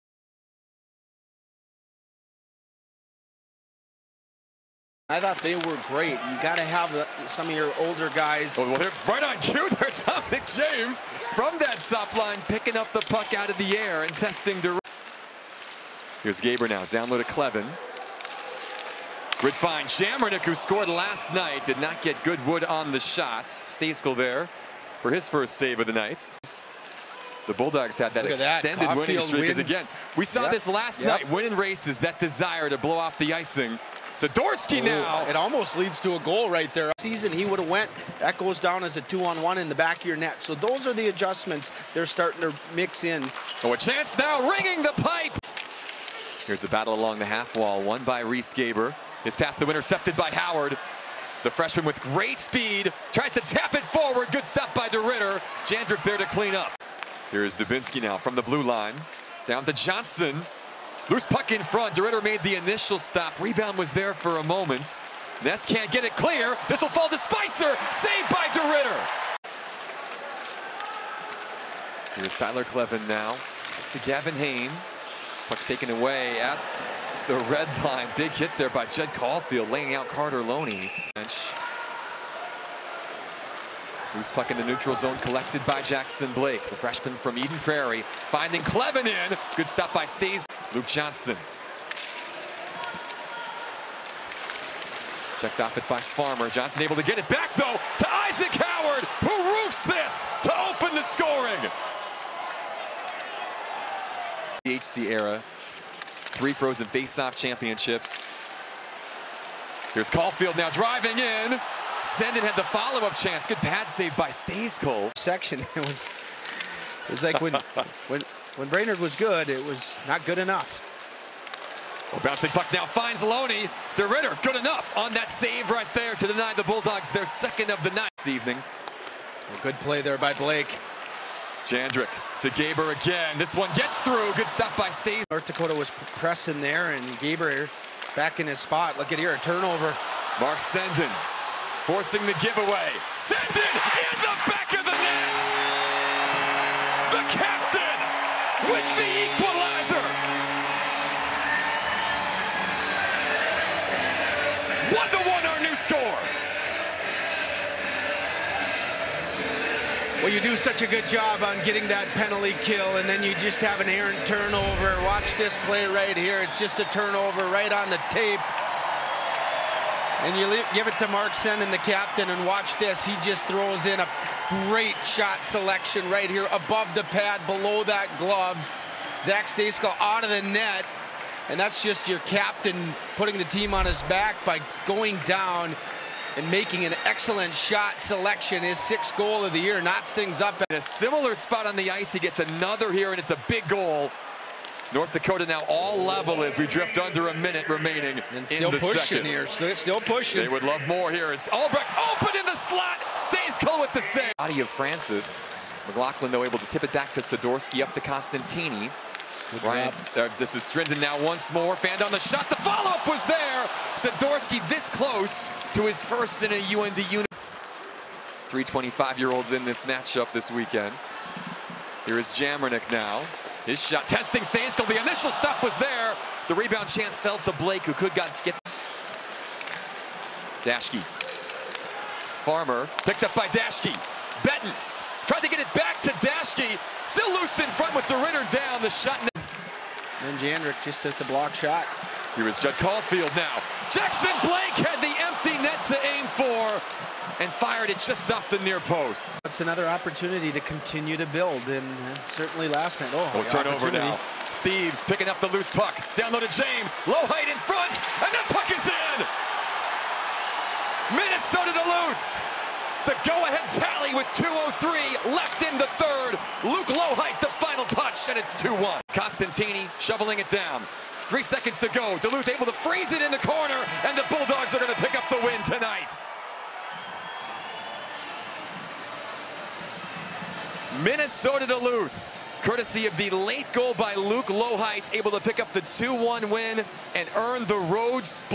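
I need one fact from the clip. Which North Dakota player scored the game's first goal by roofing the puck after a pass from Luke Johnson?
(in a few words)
Isaac Howard.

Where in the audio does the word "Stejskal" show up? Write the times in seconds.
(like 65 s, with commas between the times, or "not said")
23 s, 114 s, 179 s, 224 s.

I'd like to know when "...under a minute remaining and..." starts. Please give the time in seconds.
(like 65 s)
196 s.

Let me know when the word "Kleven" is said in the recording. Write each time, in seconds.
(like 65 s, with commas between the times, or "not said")
17 s, 72 s, 88 s.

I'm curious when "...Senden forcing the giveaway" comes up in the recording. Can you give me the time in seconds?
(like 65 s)
140 s.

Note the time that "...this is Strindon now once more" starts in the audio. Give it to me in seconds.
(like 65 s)
210 s.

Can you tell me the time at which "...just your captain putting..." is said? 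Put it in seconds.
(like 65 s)
181 s.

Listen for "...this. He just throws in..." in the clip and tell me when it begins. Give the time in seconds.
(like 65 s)
172 s.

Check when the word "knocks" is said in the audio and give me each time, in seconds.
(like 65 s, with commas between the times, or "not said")
189 s.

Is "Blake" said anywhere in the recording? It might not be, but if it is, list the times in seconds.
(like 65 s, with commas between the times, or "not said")
86 s, 130 s, 227 s, 244 s.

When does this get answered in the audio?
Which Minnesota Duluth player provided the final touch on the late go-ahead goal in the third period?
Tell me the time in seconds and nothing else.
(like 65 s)
266 s.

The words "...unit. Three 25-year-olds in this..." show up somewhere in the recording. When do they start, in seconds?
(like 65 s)
217 s.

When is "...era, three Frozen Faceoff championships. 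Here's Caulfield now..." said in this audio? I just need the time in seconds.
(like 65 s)
105 s.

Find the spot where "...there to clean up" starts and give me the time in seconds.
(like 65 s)
56 s.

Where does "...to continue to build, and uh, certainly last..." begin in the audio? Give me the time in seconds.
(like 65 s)
250 s.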